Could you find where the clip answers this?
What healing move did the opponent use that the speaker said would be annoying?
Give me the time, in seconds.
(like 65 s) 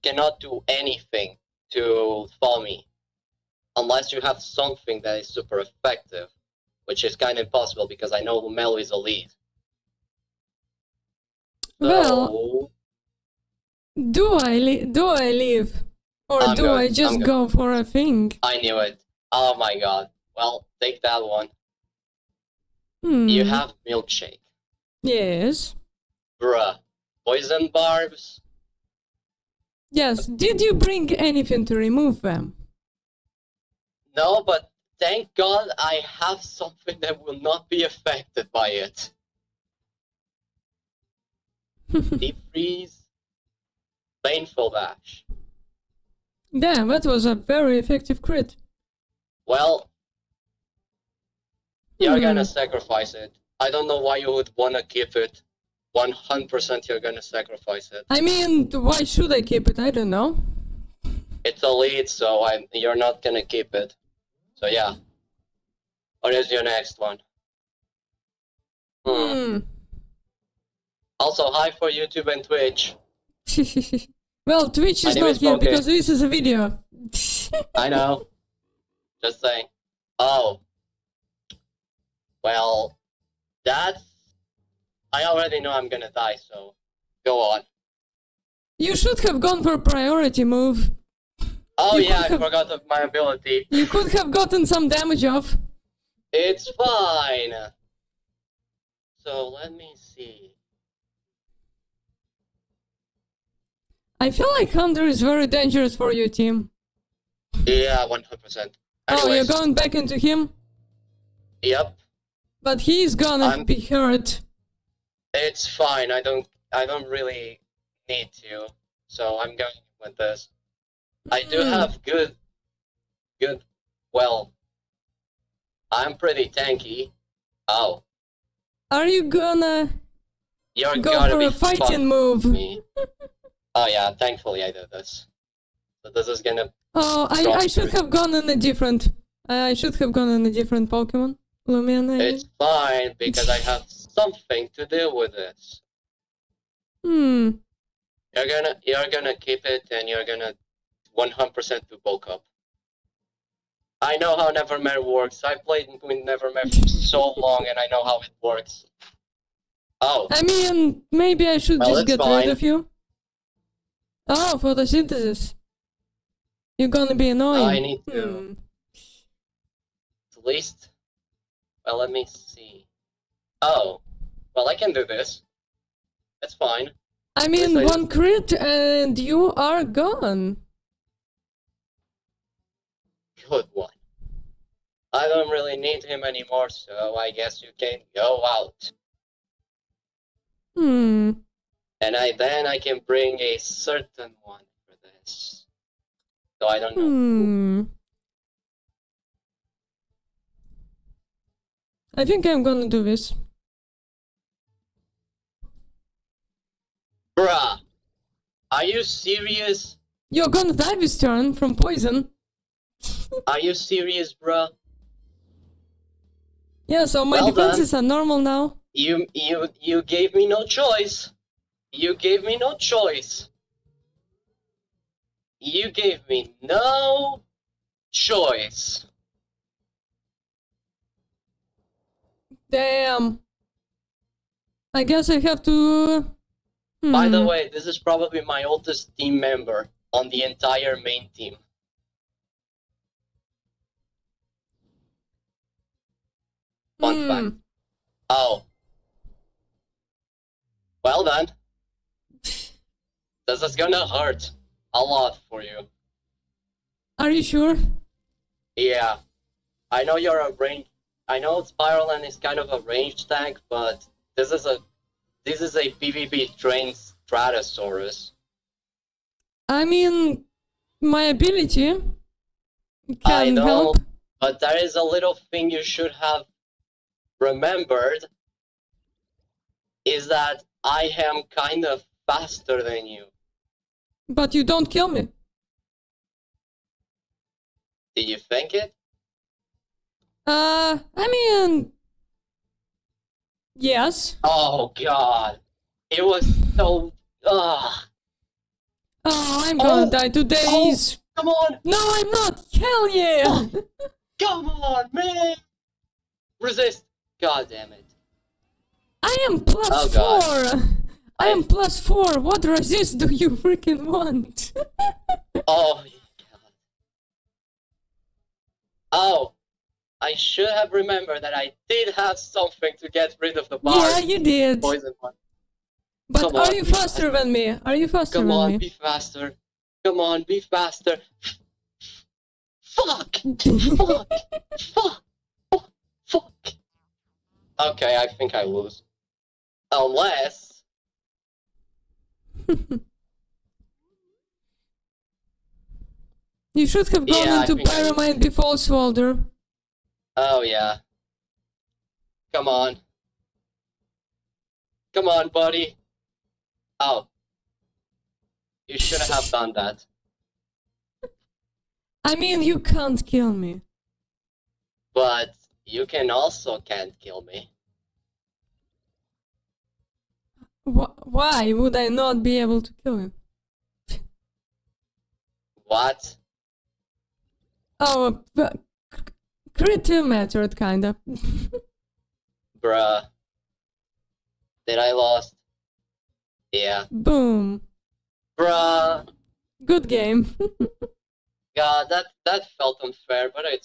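164 s.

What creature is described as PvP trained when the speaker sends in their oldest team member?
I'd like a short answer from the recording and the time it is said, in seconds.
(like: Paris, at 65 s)
Stratosaurus, at 267 s.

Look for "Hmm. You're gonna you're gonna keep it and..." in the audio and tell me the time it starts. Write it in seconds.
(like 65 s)
147 s.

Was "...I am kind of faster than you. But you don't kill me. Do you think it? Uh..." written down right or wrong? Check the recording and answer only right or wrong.
right.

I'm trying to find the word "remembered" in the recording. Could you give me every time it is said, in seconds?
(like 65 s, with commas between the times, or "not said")
277 s, 320 s.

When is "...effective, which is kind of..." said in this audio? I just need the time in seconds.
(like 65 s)
5 s.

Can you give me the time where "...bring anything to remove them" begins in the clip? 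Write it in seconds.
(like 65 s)
30 s.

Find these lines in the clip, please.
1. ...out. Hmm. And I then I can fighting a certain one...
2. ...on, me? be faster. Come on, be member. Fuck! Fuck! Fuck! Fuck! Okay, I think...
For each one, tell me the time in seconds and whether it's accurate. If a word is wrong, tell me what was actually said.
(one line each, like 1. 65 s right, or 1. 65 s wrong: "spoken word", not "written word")
1. 188 s wrong: "bring", not "fighting"
2. 328 s wrong: "faster", not "member".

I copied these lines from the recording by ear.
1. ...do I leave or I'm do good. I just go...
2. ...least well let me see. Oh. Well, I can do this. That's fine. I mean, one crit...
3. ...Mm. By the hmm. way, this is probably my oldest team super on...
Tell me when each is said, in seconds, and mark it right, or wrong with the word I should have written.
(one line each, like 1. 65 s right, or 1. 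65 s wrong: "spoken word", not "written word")
1. 14 s right
2. 170 s right
3. 237 s wrong: "member", not "super".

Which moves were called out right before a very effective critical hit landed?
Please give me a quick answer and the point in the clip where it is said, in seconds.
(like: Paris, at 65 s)
Deep freeze, painful bash, at 42 s.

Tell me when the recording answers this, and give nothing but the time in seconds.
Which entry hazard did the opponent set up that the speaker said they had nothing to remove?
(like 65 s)
27 s.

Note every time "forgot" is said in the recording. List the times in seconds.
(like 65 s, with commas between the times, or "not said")
92 s.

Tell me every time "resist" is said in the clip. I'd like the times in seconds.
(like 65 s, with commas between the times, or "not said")
306 s, 312 s.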